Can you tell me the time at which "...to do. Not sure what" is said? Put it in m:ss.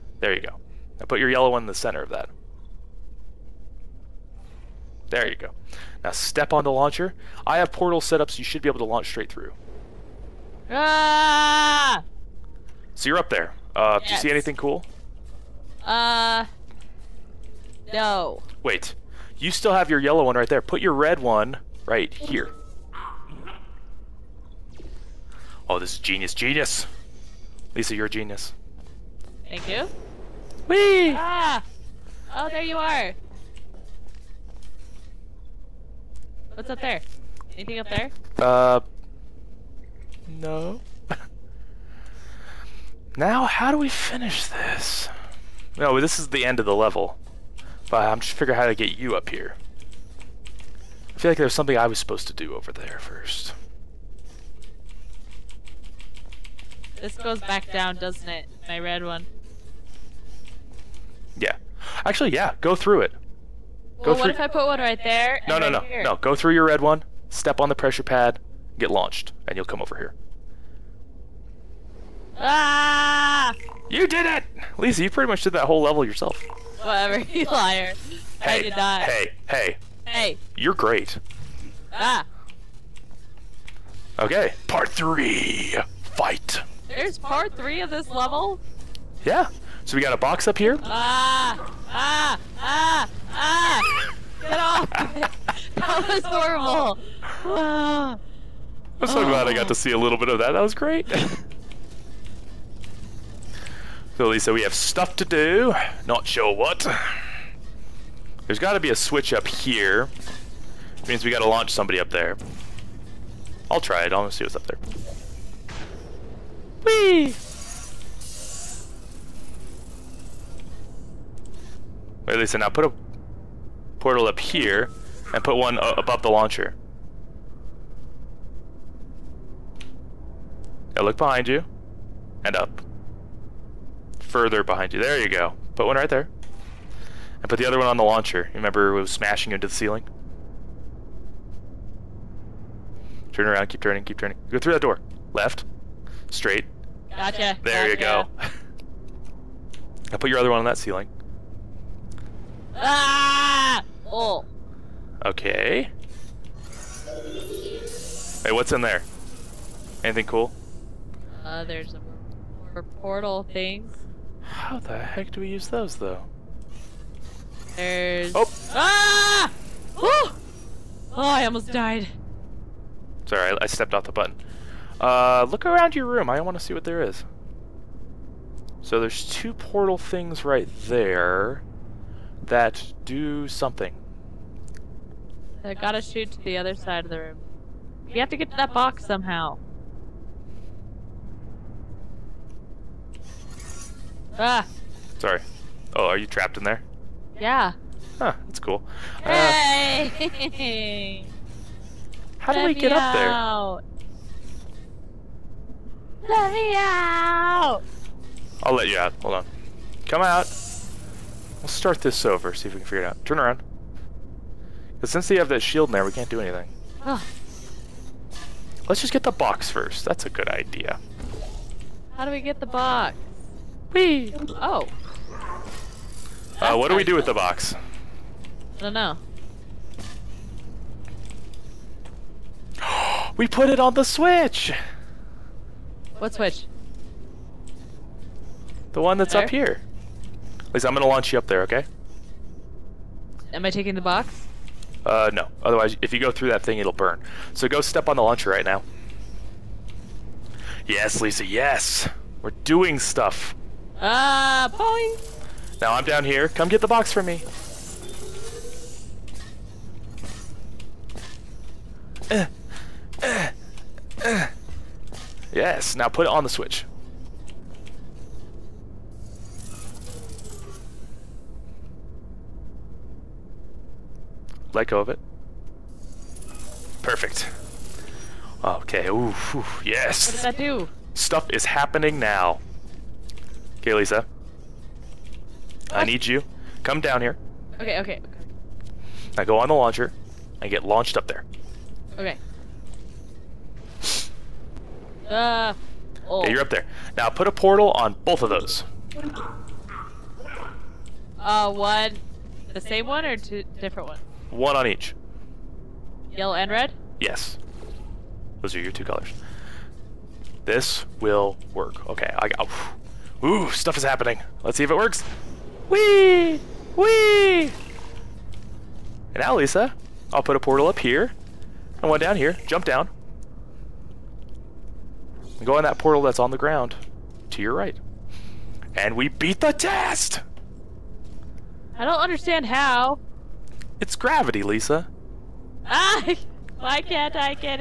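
1:45.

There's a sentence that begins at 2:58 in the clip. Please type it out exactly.
So there's two portal things right there that do something.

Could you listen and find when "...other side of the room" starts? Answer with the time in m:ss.
3:06.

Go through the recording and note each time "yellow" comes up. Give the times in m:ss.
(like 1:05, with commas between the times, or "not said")
0:01, 0:19, 5:06.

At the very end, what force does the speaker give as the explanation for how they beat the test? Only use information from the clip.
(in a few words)
Gravity.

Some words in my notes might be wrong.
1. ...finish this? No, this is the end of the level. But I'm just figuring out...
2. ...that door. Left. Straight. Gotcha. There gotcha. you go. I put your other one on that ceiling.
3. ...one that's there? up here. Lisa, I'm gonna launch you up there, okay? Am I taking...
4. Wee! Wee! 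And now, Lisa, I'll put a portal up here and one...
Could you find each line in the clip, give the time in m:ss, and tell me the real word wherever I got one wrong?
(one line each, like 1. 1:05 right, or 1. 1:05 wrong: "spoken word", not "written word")
1. 0:43 right
2. 2:24 right
3. 3:59 right
4. 5:15 right.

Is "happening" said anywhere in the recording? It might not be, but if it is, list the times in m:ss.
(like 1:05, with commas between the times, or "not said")
4:41, 5:14.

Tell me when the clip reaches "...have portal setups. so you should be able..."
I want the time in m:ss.
0:07.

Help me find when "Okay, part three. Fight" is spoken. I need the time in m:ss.
1:24.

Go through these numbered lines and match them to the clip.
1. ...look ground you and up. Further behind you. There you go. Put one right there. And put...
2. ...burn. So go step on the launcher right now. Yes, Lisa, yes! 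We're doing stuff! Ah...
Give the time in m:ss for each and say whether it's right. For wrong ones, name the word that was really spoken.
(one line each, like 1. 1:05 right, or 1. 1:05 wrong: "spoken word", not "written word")
1. 2:11 wrong: "behind", not "ground"
2. 4:06 right.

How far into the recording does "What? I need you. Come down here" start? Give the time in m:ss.
4:45.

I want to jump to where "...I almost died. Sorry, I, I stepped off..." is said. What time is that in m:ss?
2:51.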